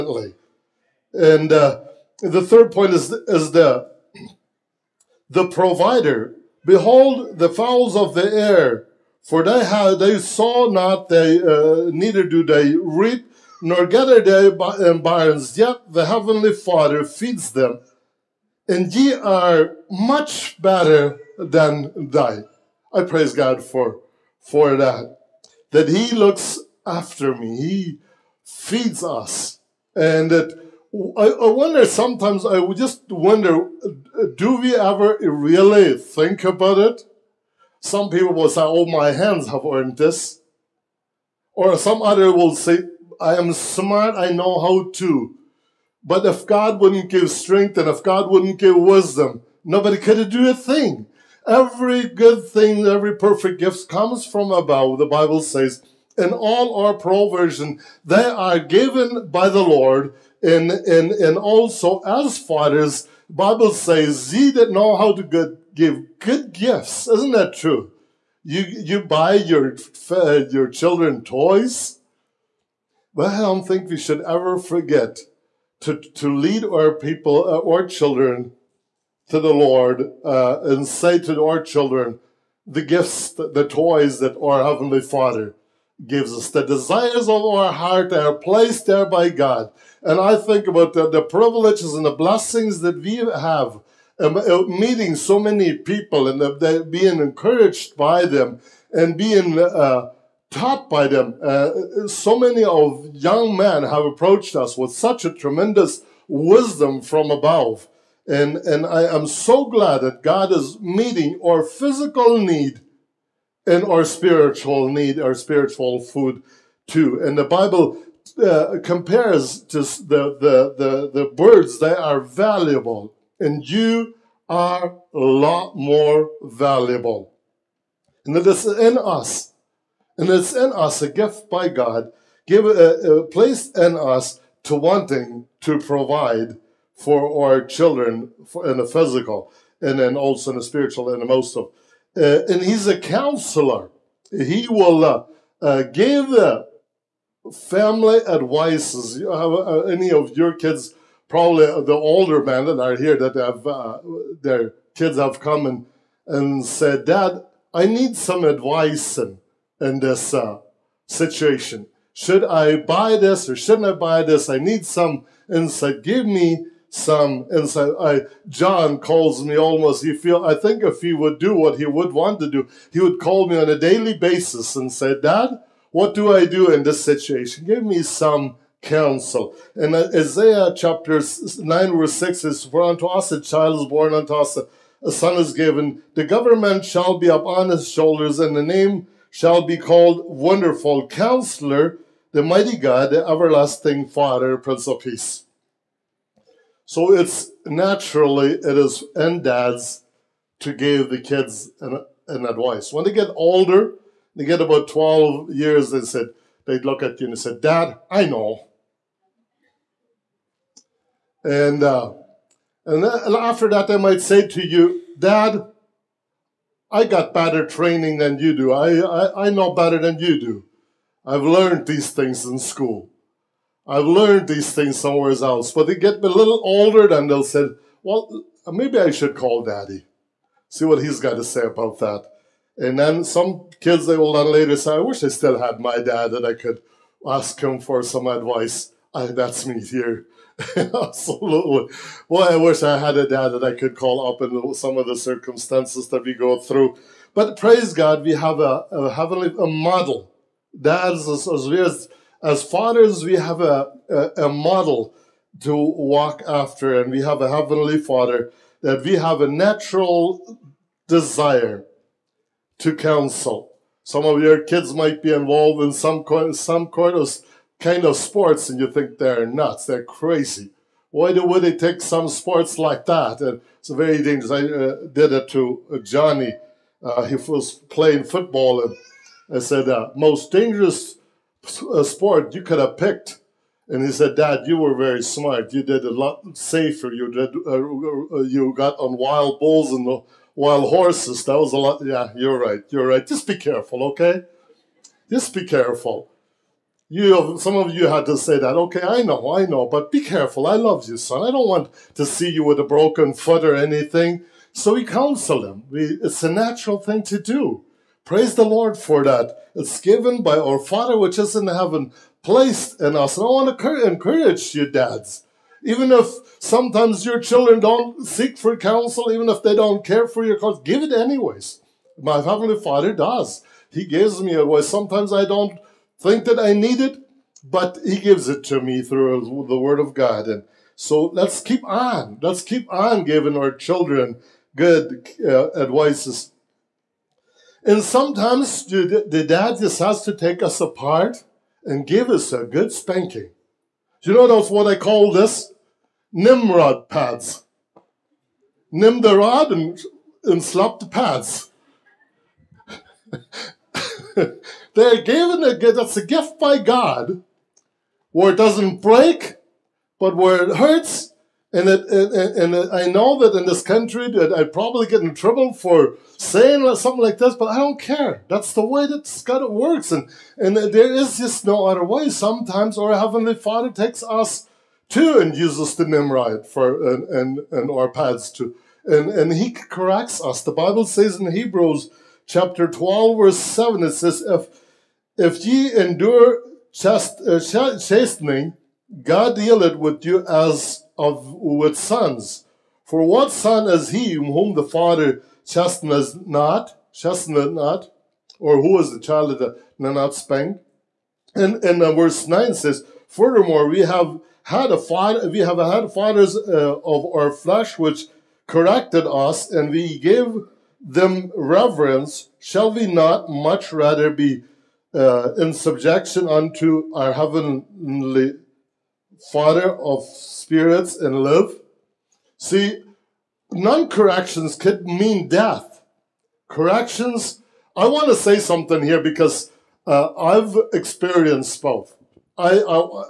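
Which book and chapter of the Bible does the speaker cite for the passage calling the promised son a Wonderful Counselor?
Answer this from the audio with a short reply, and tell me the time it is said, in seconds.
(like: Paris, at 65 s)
Isaiah chapter 9, at 180 s.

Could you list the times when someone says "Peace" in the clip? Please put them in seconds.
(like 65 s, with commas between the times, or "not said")
195 s.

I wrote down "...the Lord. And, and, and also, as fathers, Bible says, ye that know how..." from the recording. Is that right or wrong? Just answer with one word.
right.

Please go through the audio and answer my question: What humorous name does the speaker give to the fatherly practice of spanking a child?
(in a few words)
Nimrod pads.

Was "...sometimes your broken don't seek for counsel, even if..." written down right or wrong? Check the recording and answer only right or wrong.
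wrong.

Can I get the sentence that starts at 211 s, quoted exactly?
And, uh, and after that, they might say to you, Dad, I got better training than you do.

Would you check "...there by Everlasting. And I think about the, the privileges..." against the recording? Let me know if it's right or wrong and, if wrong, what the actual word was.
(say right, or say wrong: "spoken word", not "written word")
wrong: "God", not "Everlasting".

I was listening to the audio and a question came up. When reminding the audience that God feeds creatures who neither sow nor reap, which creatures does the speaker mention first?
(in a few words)
The fowls of the air.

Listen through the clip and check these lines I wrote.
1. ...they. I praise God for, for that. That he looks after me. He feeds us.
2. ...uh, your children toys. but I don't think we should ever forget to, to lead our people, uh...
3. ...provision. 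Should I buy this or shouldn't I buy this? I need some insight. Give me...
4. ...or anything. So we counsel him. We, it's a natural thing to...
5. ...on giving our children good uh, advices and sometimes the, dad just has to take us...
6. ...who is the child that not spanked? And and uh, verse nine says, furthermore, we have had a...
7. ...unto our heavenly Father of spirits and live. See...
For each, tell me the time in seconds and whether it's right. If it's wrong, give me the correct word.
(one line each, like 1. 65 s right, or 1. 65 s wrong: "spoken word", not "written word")
1. 22 s right
2. 70 s right
3. 161 s wrong: "situation", not "provision"
4. 303 s right
5. 332 s right
6. 398 s right
7. 416 s right.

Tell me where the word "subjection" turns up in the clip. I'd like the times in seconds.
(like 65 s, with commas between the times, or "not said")
415 s.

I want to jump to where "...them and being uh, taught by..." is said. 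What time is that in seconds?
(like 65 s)
98 s.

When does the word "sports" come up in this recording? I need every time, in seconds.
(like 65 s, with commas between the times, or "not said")
268 s, 272 s, 282 s.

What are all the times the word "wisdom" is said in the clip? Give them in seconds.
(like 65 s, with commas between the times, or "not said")
48 s, 106 s.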